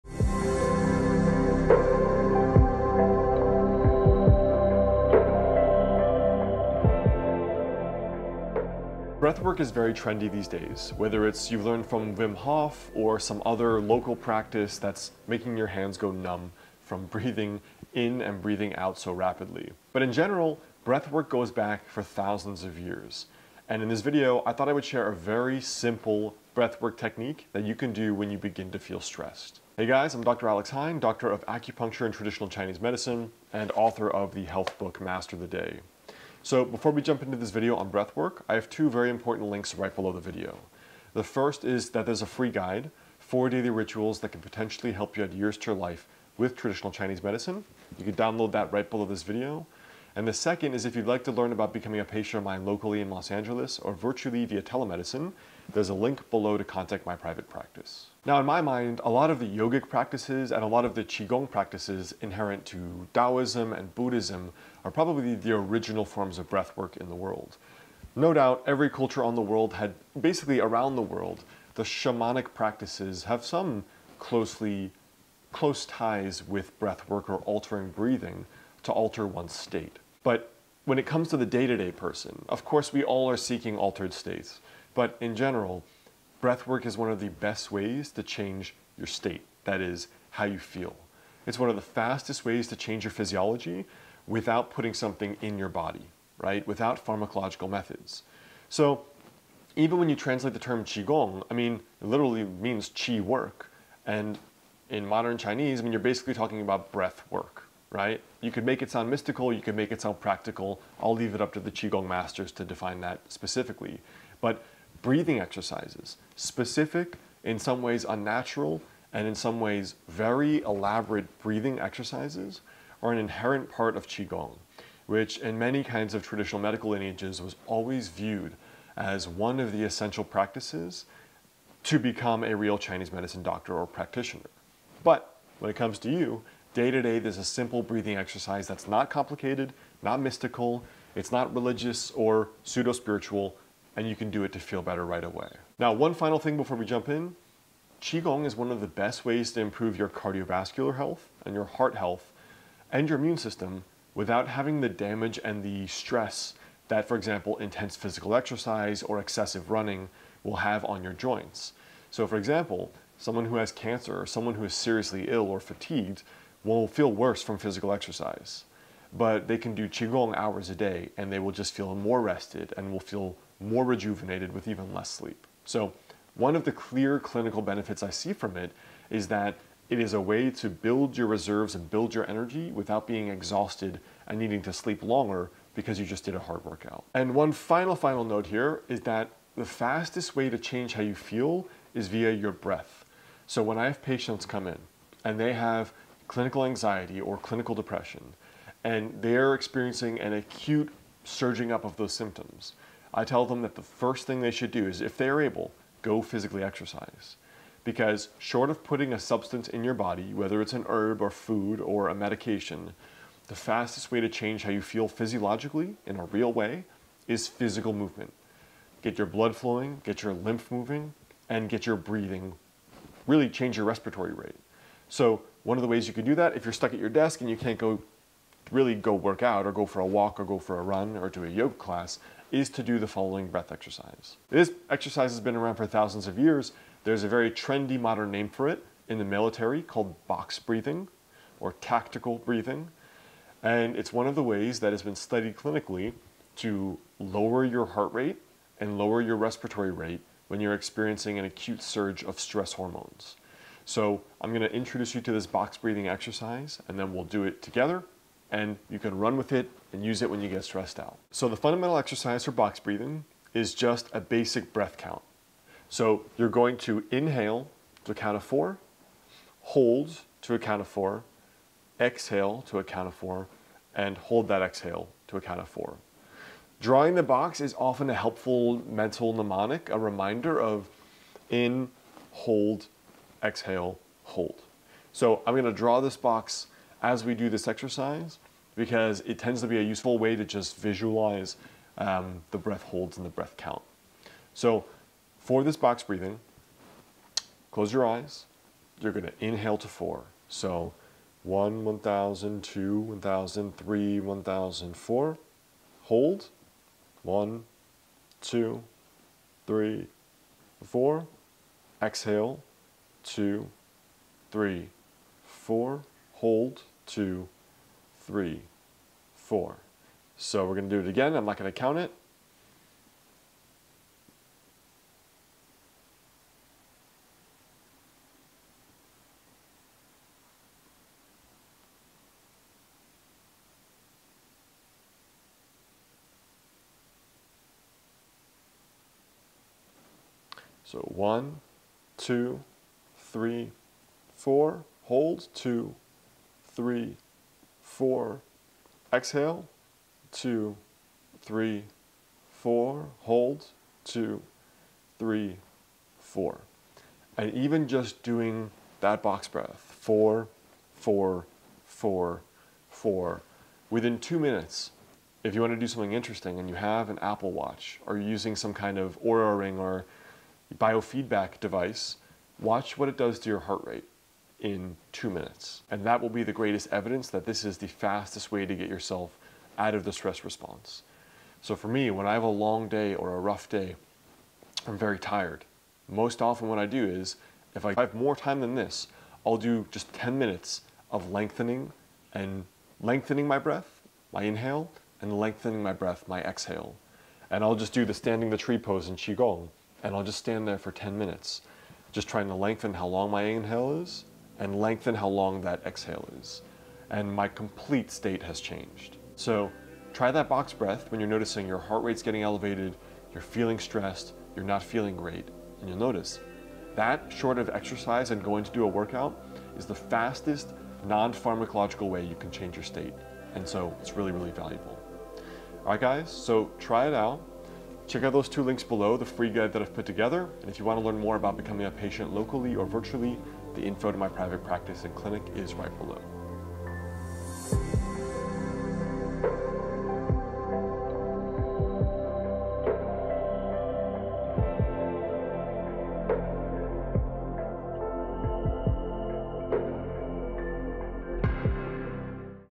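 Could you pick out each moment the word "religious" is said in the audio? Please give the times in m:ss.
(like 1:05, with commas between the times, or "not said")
2:21.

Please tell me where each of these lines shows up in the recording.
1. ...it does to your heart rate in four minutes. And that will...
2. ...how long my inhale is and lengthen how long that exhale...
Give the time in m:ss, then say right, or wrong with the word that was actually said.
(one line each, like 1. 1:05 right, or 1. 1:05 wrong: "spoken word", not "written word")
1. 6:13 wrong: "two", not "four"
2. 6:42 right.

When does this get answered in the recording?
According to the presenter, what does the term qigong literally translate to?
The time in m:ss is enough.
1:42.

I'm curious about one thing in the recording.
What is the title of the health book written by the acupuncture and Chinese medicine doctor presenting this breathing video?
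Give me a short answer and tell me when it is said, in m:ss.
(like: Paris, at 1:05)
Master the Day, at 0:34.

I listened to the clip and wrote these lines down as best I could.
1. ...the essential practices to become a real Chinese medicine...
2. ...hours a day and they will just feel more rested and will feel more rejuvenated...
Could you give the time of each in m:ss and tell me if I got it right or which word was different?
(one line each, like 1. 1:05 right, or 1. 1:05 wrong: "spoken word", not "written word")
1. 2:09 right
2. 2:50 right.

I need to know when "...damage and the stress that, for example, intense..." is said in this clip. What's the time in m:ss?
2:34.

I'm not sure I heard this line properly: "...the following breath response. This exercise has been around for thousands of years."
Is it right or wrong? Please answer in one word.
wrong.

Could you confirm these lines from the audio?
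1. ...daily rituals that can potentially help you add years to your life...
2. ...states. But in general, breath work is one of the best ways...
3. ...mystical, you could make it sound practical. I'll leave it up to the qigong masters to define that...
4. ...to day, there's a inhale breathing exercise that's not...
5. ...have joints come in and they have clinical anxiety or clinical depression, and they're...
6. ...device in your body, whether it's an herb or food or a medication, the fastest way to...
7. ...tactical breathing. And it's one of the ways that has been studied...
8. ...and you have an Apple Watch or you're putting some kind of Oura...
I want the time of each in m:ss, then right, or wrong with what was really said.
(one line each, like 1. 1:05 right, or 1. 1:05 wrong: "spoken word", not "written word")
1. 0:43 right
2. 1:24 right
3. 1:49 right
4. 2:16 wrong: "simple", not "inhale"
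5. 3:13 wrong: "patients", not "joints"
6. 3:29 wrong: "substance", not "device"
7. 4:01 right
8. 6:06 wrong: "using", not "putting".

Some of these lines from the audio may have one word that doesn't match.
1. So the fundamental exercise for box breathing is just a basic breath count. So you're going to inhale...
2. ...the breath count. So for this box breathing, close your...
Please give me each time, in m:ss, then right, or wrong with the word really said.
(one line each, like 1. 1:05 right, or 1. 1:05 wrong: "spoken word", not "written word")
1. 4:21 right
2. 4:53 right.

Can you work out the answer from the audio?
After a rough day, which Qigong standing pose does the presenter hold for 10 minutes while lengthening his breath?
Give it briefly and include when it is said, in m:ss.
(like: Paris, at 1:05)
Tree pose, at 6:38.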